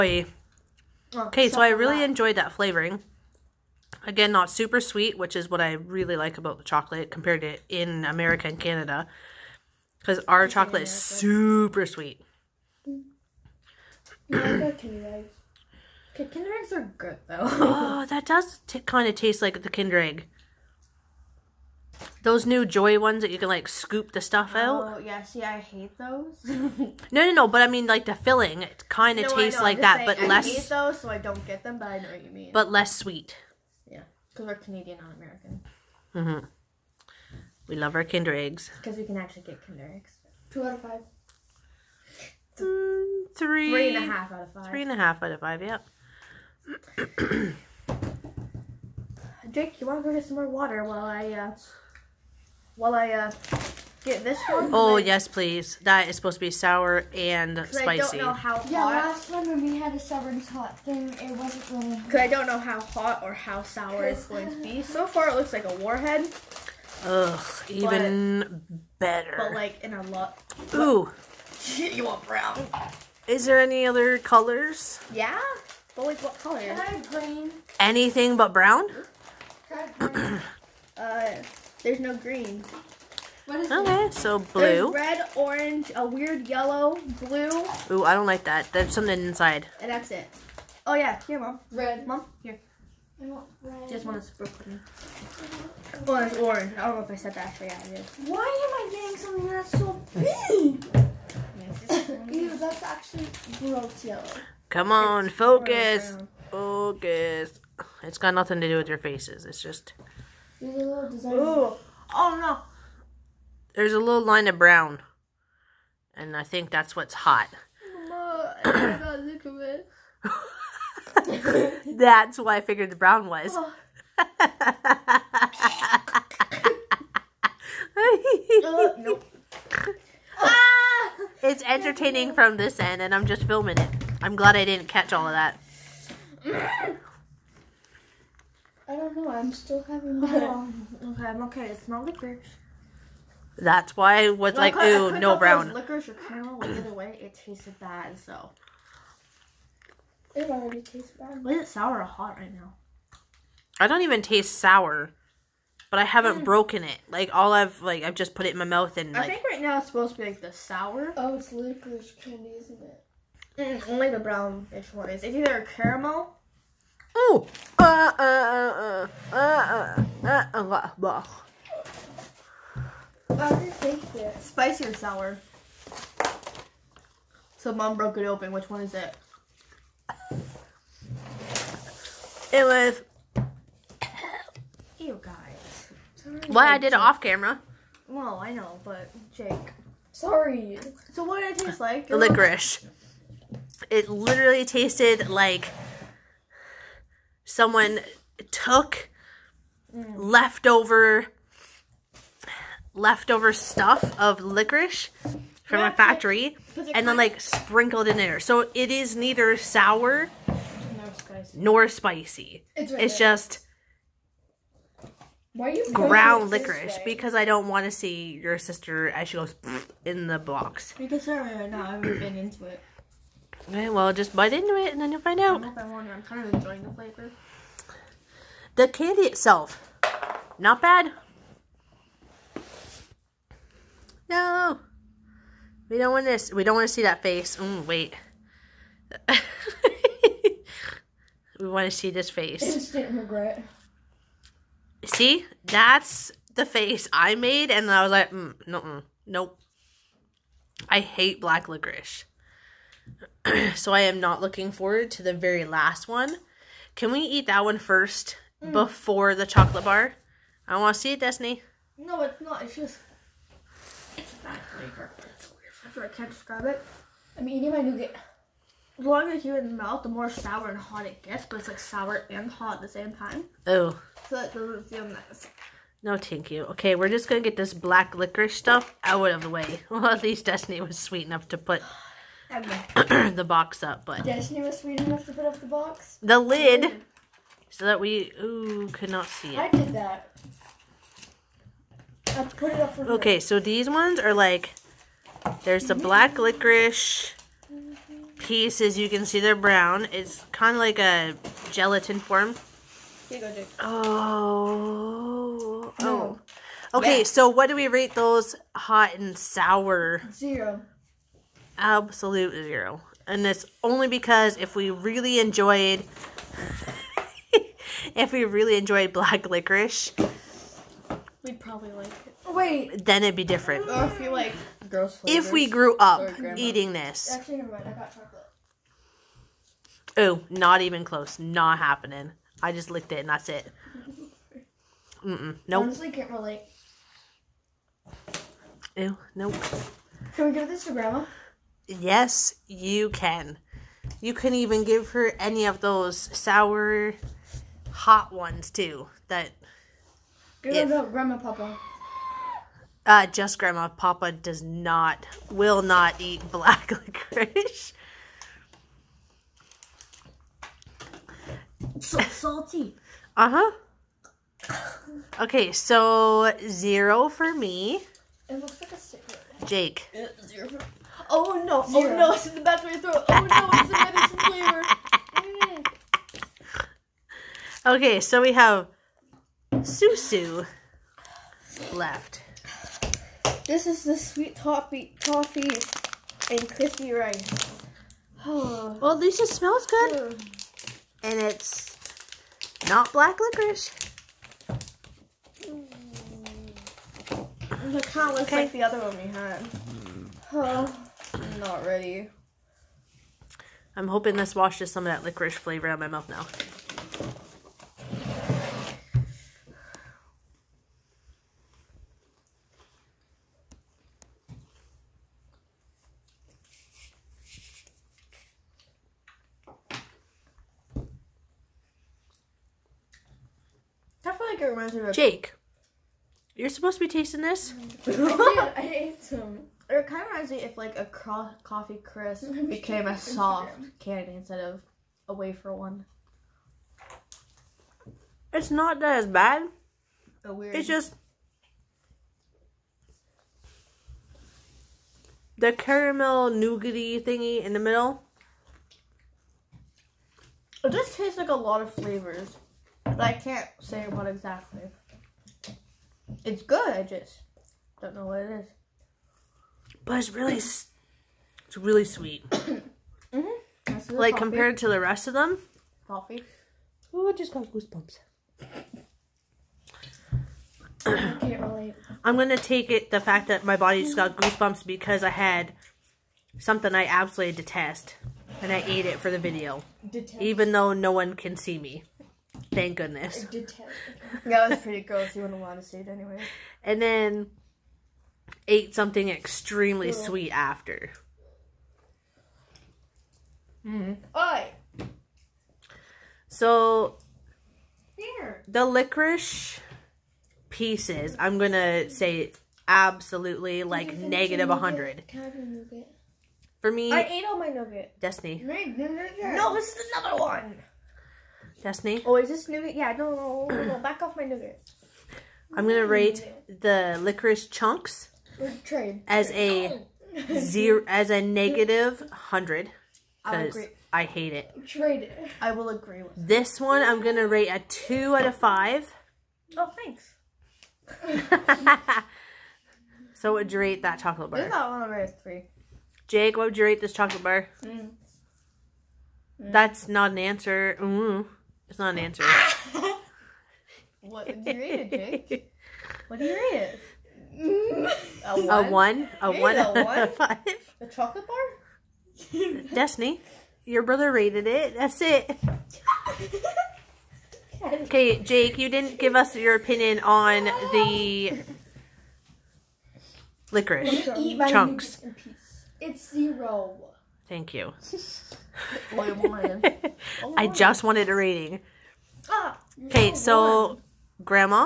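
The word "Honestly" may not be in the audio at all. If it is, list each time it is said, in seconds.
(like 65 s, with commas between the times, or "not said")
335 s.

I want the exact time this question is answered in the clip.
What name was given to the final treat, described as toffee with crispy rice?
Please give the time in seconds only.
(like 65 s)
379 s.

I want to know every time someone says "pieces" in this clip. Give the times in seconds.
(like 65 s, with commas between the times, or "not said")
298 s, 500 s.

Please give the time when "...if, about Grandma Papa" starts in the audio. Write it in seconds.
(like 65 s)
350 s.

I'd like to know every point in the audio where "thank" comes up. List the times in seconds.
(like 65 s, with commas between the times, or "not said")
276 s, 482 s, 530 s, 567 s.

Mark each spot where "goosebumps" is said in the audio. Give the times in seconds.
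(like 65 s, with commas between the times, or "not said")
467 s, 474 s.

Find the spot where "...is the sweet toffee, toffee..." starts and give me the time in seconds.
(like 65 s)
383 s.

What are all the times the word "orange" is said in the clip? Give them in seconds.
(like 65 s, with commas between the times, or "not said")
85 s, 96 s.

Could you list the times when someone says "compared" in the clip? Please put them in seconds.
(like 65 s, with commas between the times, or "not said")
7 s, 464 s.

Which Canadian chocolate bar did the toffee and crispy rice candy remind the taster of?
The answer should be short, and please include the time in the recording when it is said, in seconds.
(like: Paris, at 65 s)
Coffee Crisp, at 431 s.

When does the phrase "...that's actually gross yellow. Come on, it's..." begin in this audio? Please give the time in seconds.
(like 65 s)
102 s.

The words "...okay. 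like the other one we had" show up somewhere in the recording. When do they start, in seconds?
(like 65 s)
398 s.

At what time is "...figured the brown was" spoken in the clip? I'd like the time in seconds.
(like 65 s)
122 s.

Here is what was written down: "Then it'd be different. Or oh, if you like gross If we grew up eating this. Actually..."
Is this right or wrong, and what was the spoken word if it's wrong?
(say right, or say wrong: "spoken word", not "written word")
right.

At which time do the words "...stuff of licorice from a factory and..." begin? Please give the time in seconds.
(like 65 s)
203 s.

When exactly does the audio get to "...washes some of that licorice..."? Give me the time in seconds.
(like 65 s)
404 s.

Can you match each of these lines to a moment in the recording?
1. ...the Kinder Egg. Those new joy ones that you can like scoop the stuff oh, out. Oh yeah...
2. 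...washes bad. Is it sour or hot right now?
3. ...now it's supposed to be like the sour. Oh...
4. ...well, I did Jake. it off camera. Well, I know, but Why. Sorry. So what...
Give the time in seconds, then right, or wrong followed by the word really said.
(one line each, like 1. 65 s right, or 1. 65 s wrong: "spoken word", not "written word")
1. 19 s right
2. 150 s wrong: "tastes", not "washes"
3. 159 s right
4. 186 s wrong: "Jake", not "Why".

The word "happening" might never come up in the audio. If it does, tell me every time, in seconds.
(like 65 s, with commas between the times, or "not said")
331 s.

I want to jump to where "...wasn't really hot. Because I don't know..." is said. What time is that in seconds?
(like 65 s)
61 s.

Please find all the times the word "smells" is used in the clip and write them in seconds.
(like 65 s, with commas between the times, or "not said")
389 s.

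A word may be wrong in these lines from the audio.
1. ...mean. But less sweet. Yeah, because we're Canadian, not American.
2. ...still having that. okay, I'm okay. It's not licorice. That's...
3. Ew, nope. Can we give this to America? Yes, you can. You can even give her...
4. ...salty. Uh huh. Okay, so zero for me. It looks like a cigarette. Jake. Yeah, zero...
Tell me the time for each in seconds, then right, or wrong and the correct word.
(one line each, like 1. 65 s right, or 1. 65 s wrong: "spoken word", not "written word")
1. 32 s right
2. 139 s right
3. 338 s wrong: "Grandma", not "America"
4. 362 s right.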